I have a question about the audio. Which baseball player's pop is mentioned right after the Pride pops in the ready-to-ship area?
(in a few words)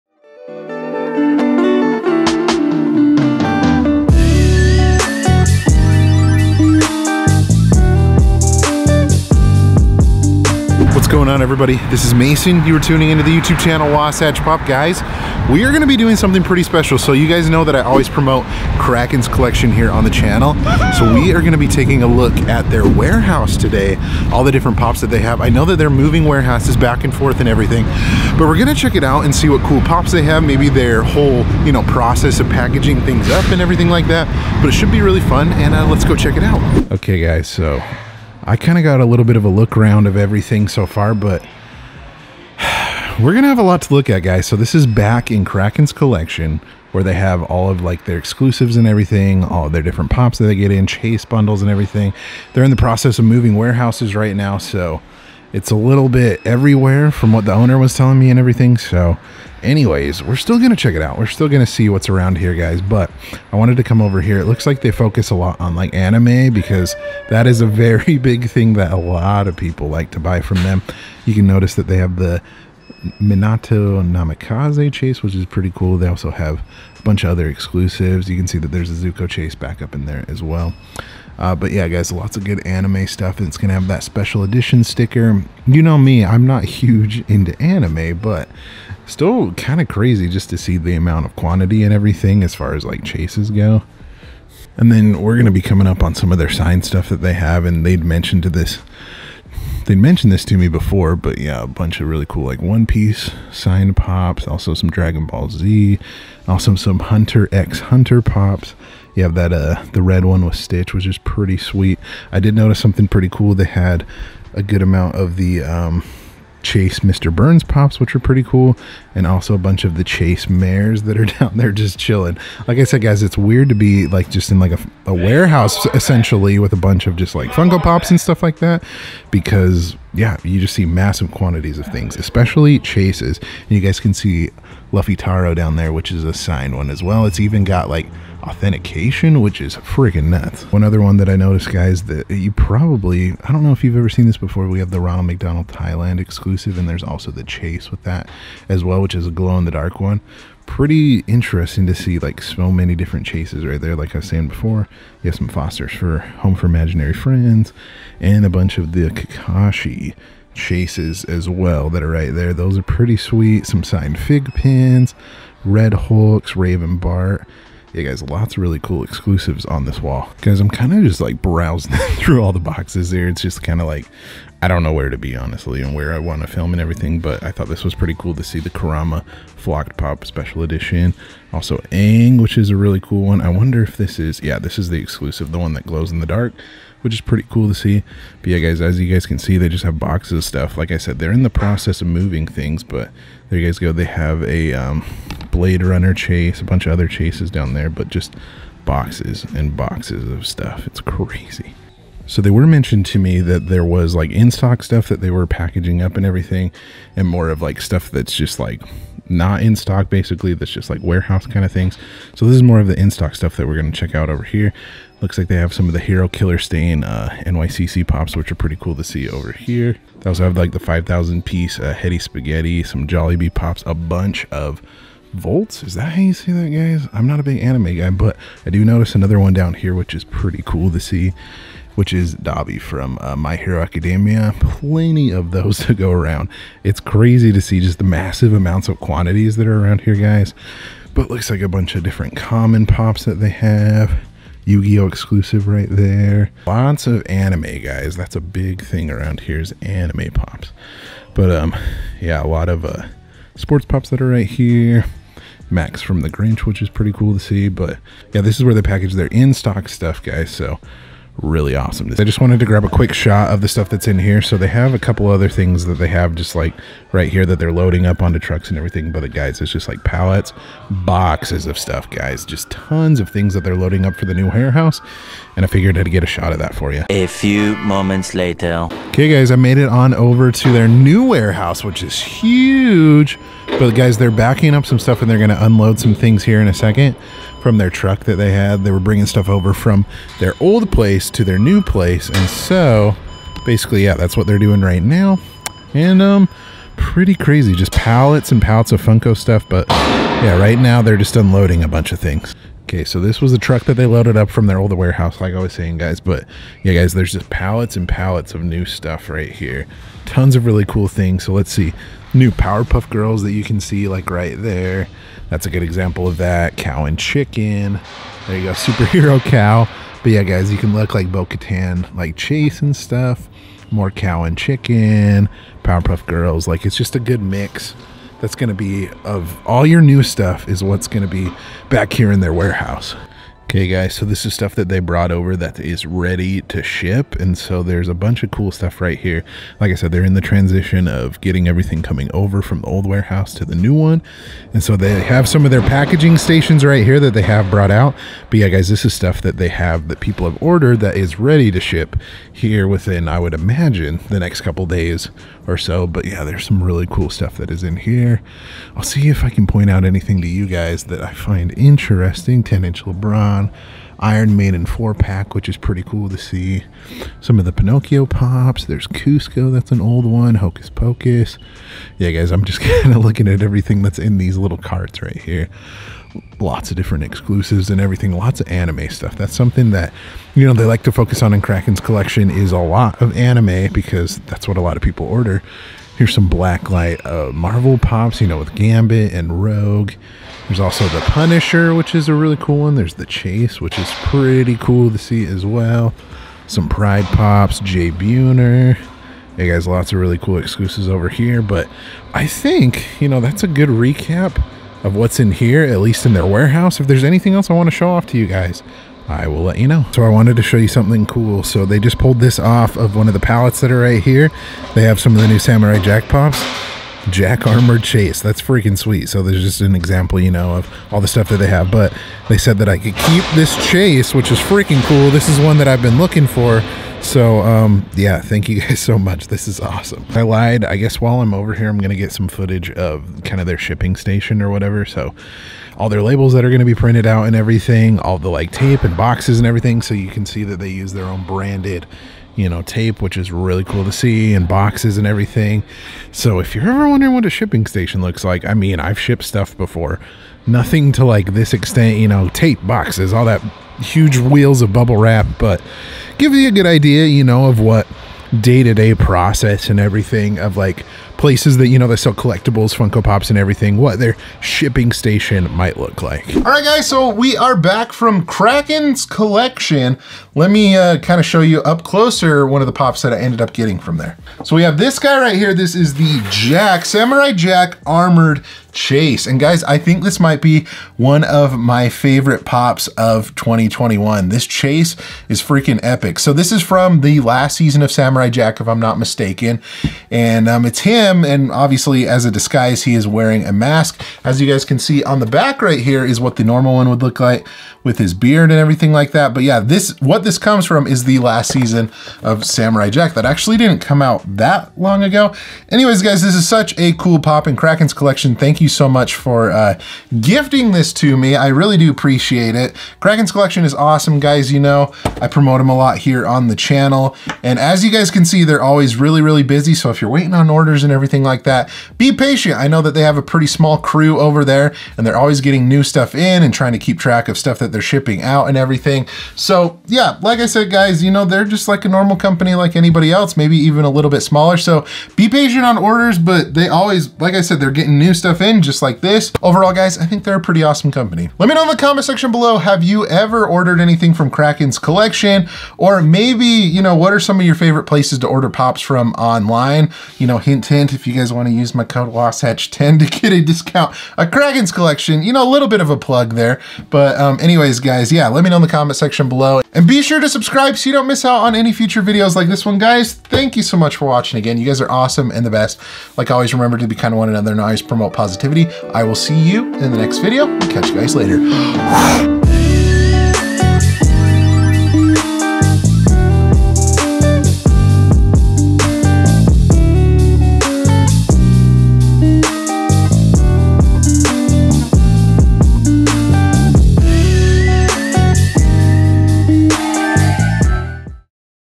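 Jay Buhner.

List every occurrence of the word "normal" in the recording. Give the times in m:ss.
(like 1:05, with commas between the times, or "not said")
8:16, 8:52.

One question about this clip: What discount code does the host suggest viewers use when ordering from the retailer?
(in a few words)
WASATCH10.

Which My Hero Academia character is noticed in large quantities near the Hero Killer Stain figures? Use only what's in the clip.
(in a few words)
Dabi.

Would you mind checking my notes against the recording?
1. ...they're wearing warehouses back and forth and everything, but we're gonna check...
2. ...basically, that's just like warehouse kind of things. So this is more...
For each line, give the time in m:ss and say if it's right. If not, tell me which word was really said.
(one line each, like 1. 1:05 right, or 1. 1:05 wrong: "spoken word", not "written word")
1. 0:25 wrong: "moving", not "wearing"
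2. 3:30 right.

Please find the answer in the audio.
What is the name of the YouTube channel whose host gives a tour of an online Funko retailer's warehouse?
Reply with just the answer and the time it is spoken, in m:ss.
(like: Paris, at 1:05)
Wasatch Pop, at 0:13.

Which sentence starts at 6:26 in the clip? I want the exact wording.
Here's some Blacklight uh, Marvel pops, you know, with Gambit and Rogue.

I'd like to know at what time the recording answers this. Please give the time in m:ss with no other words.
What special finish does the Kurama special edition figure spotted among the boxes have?
2:59.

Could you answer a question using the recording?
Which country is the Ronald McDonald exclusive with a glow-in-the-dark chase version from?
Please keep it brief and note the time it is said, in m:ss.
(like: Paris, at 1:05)
Thailand, at 2:25.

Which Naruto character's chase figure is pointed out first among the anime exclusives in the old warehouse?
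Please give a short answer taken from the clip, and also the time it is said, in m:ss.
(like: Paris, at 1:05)
Minato Namikaze, at 1:13.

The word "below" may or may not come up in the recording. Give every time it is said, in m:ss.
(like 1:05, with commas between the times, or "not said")
9:02, 9:19.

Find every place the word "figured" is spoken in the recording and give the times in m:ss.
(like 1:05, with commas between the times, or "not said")
4:35.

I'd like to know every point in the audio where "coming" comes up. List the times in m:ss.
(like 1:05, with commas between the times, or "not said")
1:35, 5:42.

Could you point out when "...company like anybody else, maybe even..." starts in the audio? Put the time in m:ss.
8:52.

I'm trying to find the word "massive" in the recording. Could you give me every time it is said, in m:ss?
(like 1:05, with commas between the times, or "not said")
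2:10, 3:58.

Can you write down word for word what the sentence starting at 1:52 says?
I did notice something pretty cool.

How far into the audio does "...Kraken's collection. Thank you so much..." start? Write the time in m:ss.
8:27.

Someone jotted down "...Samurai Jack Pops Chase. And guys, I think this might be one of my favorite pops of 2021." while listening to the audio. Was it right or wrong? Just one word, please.
wrong.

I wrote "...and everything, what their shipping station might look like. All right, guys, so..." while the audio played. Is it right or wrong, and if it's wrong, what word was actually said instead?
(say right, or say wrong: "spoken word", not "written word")
right.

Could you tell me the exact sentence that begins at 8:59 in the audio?
Overall, guys, I think they're a pretty awesome company.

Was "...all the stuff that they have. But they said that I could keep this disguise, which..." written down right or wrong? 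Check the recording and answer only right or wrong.
wrong.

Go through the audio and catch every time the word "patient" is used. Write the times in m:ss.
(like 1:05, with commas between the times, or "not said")
8:42, 8:55.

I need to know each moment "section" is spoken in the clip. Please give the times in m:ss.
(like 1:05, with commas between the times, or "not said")
9:02, 9:19.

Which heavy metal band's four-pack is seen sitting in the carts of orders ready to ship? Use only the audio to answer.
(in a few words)
Iron Maiden.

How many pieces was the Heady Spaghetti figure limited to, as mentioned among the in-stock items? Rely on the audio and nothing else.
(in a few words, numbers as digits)
5,000.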